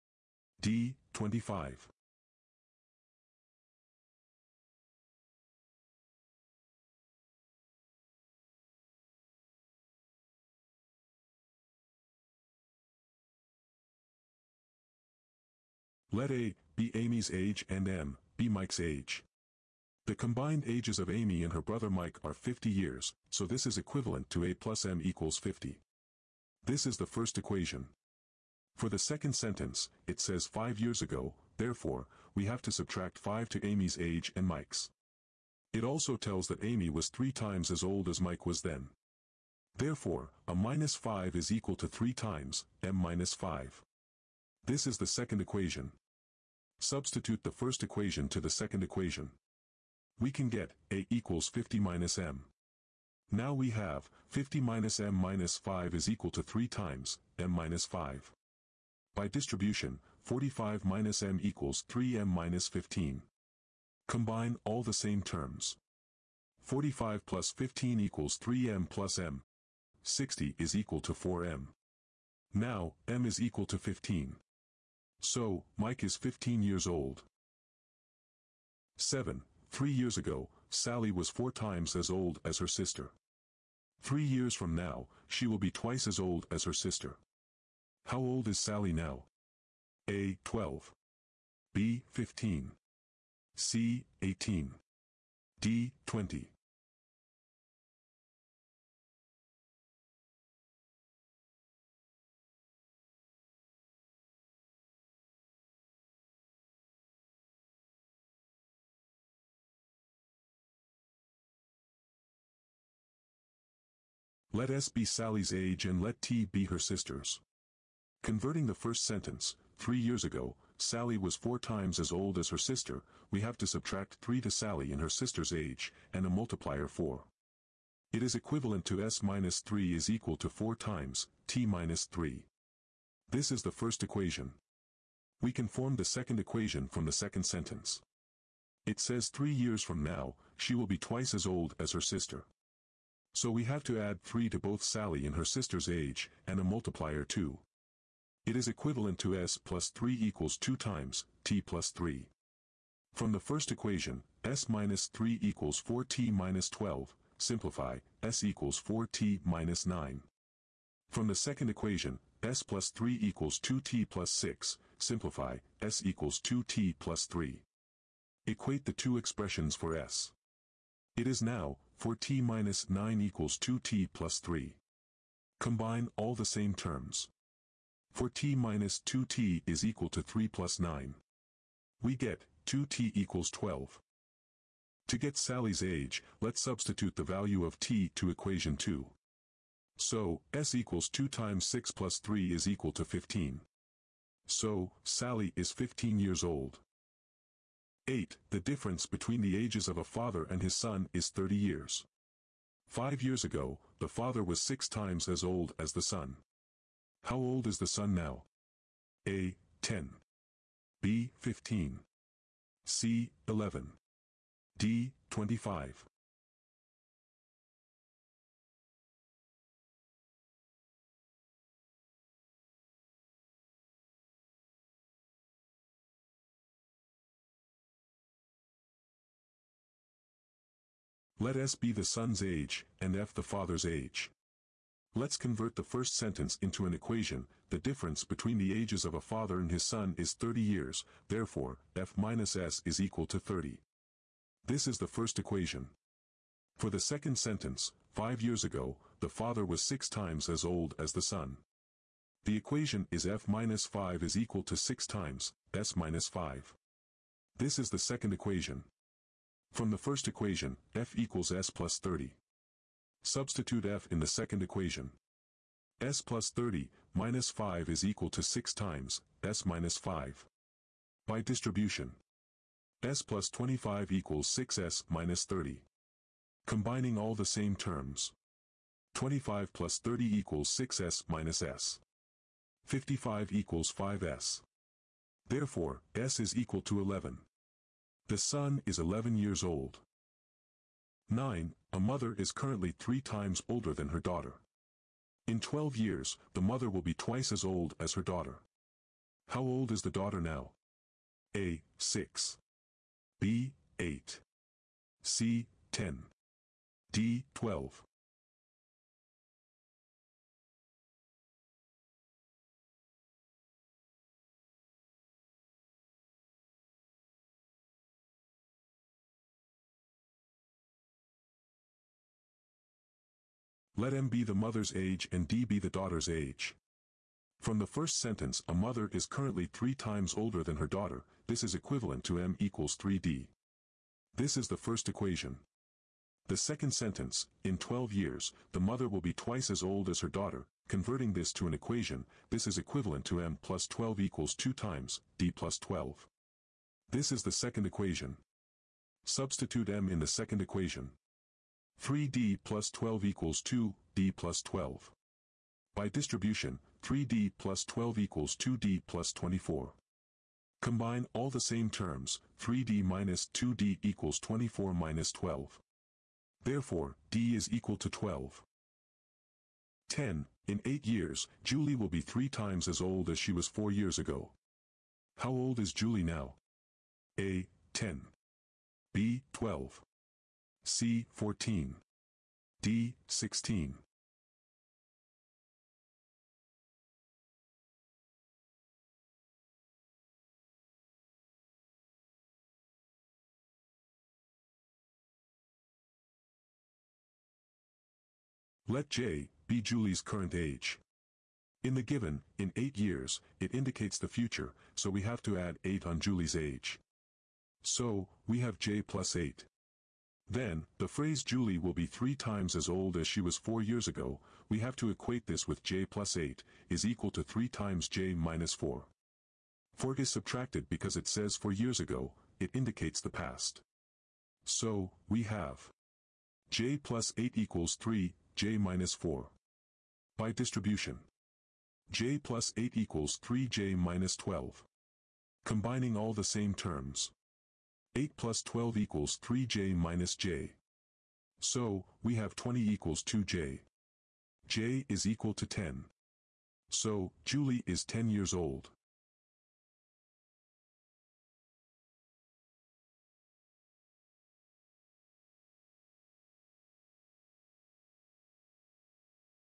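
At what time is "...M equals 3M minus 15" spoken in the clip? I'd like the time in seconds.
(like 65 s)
61 s.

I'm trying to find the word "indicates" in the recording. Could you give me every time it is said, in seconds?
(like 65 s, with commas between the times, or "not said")
403 s, 422 s.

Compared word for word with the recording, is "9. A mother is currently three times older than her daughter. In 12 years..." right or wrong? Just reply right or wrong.
right.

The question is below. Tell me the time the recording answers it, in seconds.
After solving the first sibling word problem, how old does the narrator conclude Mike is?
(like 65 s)
75 s.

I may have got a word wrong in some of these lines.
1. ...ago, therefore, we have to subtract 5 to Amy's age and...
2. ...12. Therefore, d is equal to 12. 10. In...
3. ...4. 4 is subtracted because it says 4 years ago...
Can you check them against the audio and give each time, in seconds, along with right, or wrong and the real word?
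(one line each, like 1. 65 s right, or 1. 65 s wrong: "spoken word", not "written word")
1. 31 s right
2. 365 s right
3. 418 s right.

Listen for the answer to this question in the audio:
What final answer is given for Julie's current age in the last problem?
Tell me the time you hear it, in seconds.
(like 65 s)
447 s.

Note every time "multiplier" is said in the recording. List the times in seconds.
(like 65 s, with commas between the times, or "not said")
126 s, 146 s.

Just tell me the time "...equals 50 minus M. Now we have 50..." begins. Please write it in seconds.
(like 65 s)
51 s.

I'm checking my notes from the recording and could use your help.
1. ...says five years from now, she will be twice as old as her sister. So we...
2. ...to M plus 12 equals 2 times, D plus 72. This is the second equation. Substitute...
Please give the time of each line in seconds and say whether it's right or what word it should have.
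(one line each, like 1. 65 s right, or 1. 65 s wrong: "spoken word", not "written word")
1. 138 s wrong: "three", not "five"
2. 343 s wrong: "12", not "72".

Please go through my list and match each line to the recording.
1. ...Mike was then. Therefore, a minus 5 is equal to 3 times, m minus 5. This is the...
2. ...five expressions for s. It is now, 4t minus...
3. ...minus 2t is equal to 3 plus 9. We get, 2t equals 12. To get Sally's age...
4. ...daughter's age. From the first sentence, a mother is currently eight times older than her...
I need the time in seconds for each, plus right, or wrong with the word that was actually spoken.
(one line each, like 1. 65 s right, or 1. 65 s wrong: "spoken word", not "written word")
1. 38 s right
2. 168 s wrong: "two", not "five"
3. 178 s right
4. 325 s wrong: "three", not "eight".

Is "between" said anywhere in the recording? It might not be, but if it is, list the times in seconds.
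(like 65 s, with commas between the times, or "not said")
199 s, 238 s.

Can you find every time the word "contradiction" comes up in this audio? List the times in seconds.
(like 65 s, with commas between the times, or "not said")
not said.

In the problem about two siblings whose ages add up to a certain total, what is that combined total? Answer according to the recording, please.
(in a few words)
50.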